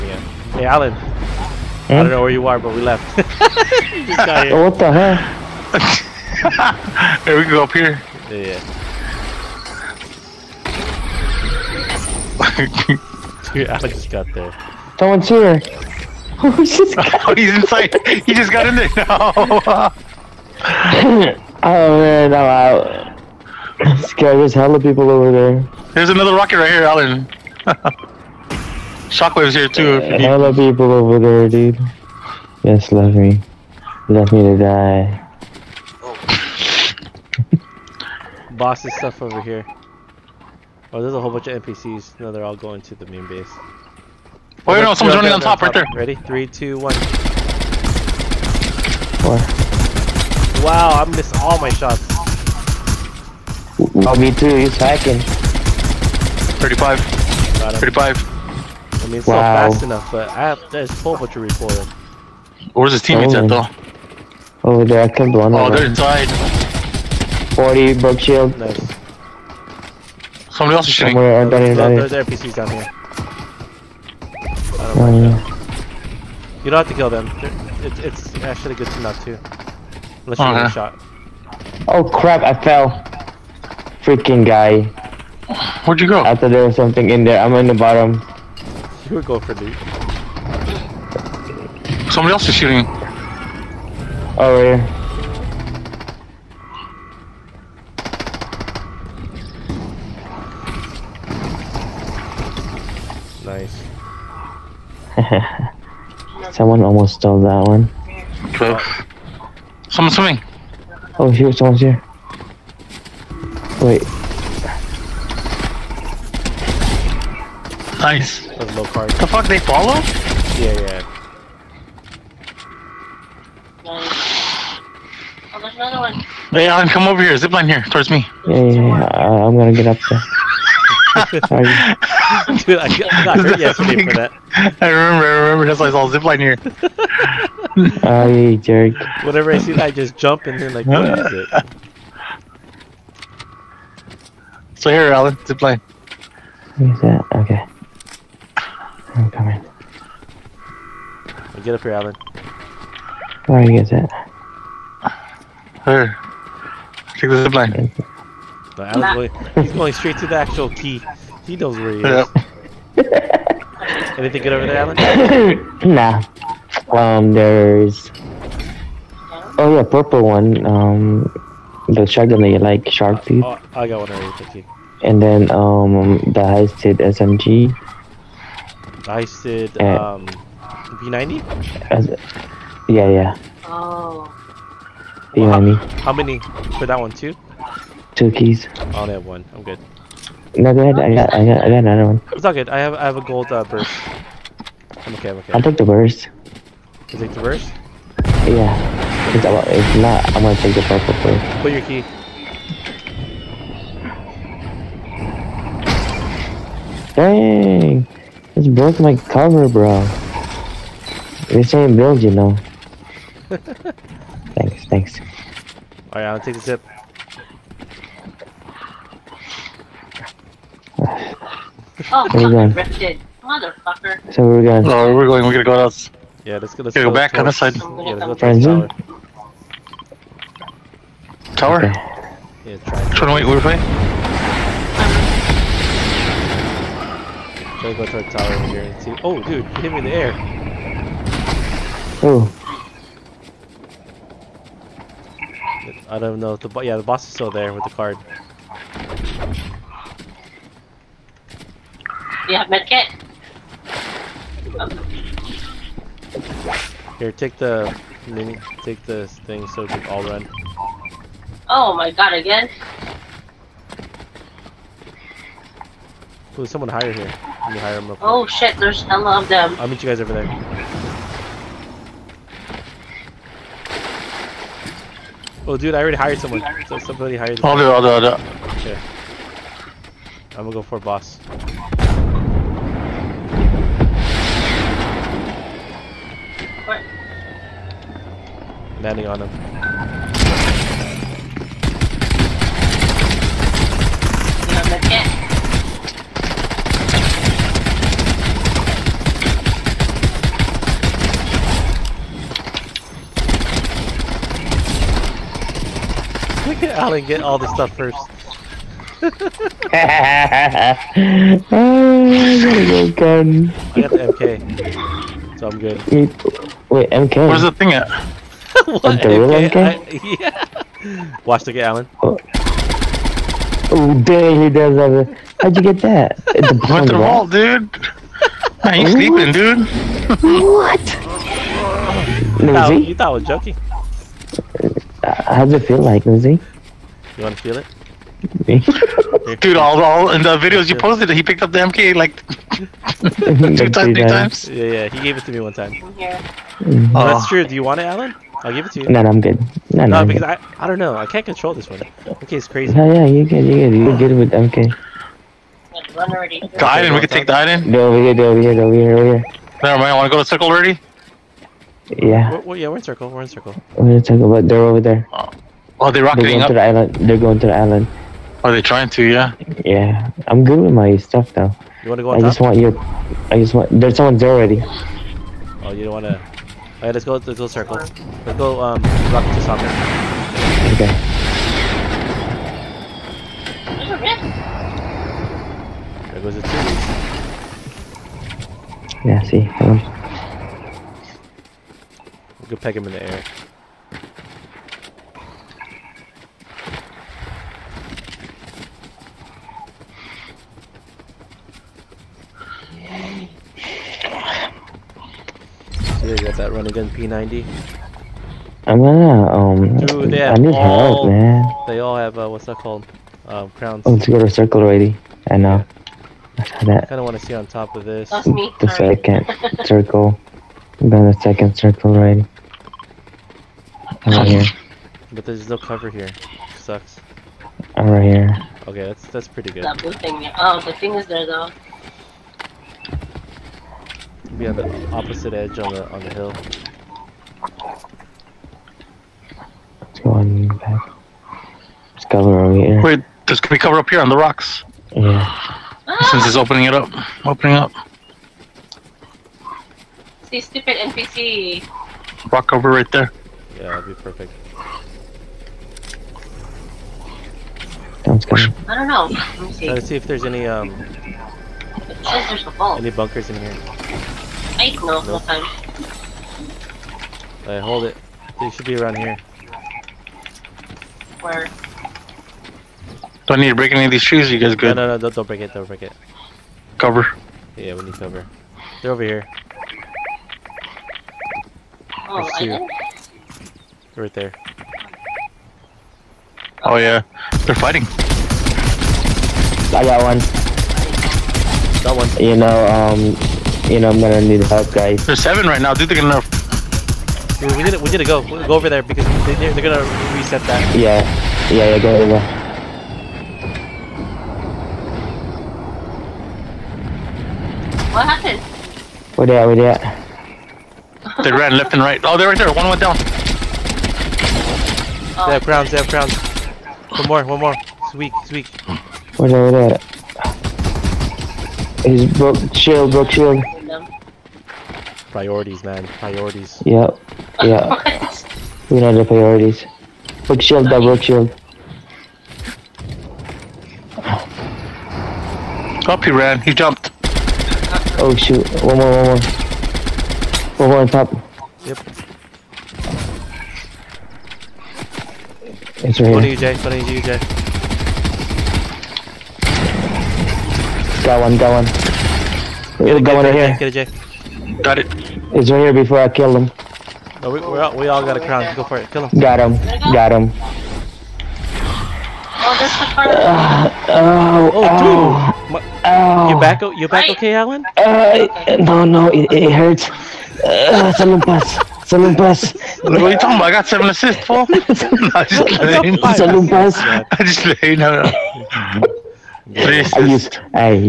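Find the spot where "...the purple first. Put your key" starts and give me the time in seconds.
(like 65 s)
200 s.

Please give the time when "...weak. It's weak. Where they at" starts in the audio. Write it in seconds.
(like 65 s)
518 s.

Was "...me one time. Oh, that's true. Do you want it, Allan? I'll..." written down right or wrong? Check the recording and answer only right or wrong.
right.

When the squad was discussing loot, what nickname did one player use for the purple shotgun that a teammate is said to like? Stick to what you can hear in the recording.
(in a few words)
shark teeth.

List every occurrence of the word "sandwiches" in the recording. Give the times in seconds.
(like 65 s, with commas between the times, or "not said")
not said.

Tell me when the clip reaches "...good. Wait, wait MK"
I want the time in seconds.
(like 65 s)
315 s.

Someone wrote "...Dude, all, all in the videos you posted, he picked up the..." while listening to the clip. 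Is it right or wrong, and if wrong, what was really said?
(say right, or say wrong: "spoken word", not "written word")
right.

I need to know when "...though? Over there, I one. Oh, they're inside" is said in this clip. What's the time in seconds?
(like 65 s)
63 s.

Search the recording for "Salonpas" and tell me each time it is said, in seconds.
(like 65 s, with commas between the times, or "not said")
572 s, 576 s.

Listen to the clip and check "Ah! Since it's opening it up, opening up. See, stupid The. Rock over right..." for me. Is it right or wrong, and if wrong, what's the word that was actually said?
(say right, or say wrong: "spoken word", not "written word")
wrong: "NPC", not "The".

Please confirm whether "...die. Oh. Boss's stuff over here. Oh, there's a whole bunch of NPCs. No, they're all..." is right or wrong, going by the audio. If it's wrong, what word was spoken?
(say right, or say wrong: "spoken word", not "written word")
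right.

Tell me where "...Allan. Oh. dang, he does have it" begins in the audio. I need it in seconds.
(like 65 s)
321 s.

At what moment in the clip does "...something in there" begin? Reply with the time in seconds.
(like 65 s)
86 s.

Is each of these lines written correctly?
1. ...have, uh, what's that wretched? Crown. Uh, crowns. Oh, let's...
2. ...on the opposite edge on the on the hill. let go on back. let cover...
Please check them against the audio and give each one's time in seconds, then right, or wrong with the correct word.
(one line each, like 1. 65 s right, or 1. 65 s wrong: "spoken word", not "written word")
1. 412 s wrong: "called", not "wretched"
2. 434 s right.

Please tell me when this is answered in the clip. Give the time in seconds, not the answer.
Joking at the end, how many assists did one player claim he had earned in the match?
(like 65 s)
573 s.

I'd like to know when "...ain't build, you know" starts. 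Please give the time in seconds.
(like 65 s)
211 s.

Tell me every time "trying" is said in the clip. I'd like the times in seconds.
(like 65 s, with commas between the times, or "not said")
233 s, 368 s.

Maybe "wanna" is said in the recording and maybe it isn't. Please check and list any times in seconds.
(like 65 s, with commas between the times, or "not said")
360 s, 372 s, 376 s, 417 s.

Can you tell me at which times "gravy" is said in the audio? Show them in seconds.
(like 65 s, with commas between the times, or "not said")
not said.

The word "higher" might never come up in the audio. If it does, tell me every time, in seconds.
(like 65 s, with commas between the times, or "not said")
266 s.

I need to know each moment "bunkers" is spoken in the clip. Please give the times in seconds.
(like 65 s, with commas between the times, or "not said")
463 s.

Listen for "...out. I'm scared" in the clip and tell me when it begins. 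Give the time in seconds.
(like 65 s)
22 s.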